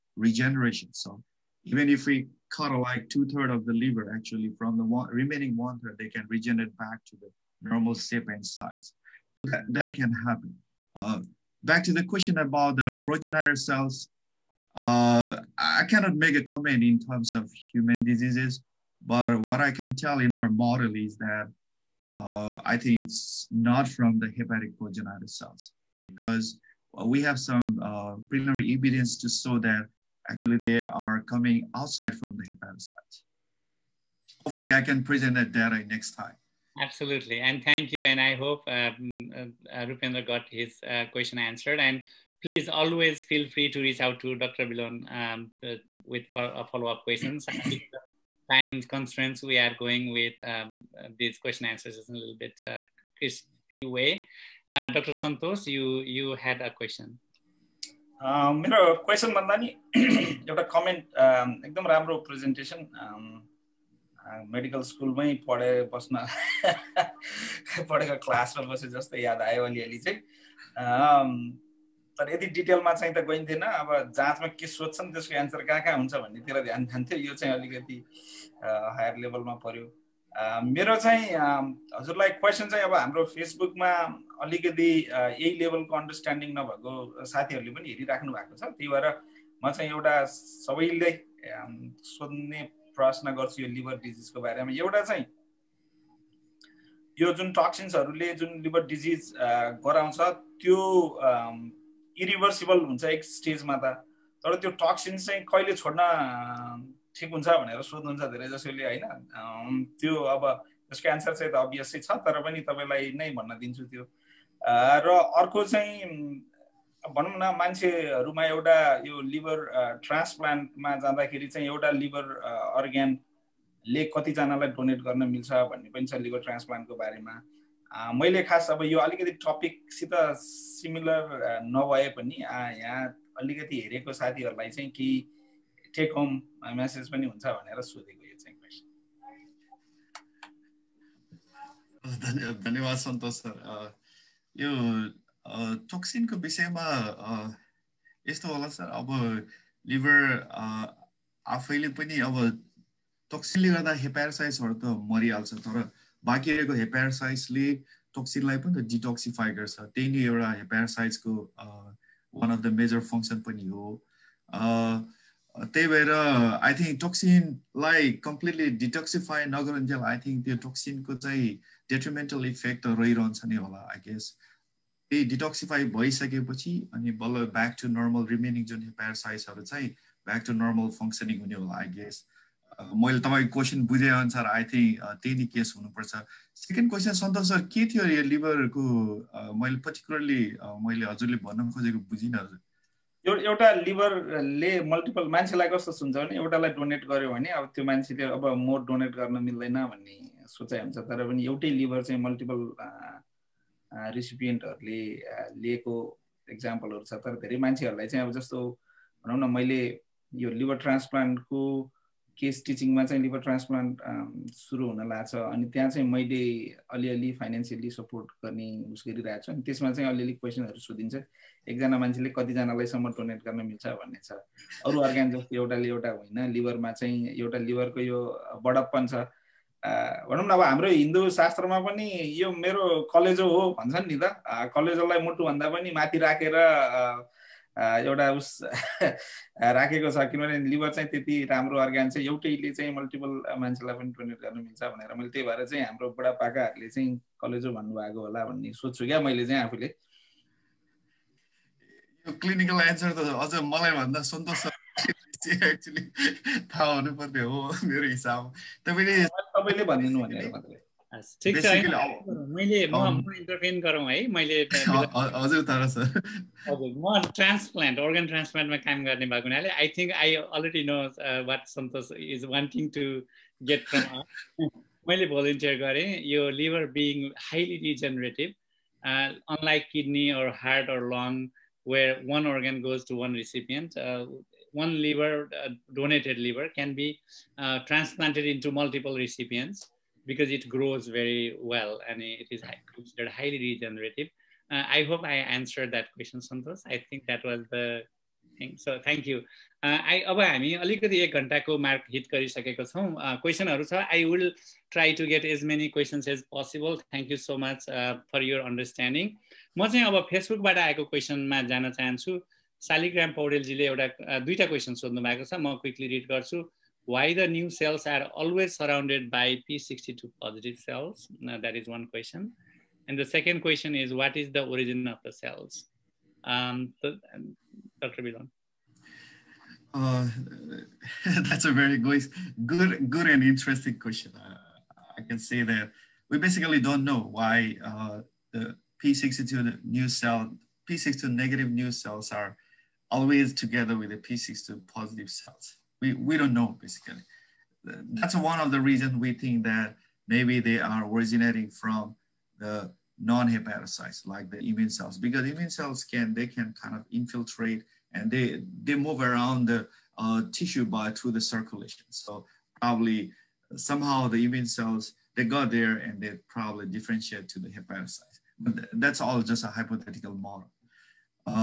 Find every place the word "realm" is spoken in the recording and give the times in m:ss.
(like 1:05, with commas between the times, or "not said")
not said.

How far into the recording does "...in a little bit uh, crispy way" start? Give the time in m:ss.
0:52.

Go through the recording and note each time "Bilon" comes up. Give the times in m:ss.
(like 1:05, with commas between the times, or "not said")
0:44, 5:28.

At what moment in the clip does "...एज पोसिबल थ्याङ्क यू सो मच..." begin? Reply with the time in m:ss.
5:06.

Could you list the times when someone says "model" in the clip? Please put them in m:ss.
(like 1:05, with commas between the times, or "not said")
0:20, 6:10.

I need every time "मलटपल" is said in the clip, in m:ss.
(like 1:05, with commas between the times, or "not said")
3:14, 3:22, 4:02, 4:48.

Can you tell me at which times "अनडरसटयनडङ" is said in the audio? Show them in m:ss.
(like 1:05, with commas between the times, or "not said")
1:25, 5:08.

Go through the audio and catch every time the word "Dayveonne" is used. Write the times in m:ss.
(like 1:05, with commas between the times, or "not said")
not said.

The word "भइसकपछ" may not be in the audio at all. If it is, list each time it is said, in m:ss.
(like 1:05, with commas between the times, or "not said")
2:55.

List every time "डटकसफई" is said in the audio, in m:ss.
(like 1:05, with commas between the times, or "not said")
2:38, 2:48, 2:55.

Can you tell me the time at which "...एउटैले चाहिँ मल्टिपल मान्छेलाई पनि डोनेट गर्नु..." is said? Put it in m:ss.
4:02.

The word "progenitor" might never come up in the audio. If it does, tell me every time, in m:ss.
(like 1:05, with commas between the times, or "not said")
0:13, 0:24.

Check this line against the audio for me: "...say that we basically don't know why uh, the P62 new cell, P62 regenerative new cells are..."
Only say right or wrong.
wrong.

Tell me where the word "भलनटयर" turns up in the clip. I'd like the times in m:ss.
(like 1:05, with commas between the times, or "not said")
4:35.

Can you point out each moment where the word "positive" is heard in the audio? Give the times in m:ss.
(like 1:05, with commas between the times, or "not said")
5:20, 5:44.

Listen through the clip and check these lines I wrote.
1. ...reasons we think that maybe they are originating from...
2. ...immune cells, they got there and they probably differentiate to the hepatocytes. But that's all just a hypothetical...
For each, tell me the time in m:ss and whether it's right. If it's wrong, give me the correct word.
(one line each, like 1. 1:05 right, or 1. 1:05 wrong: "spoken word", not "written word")
1. 5:48 right
2. 6:04 right.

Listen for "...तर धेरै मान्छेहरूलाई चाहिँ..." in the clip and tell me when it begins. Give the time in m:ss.
3:27.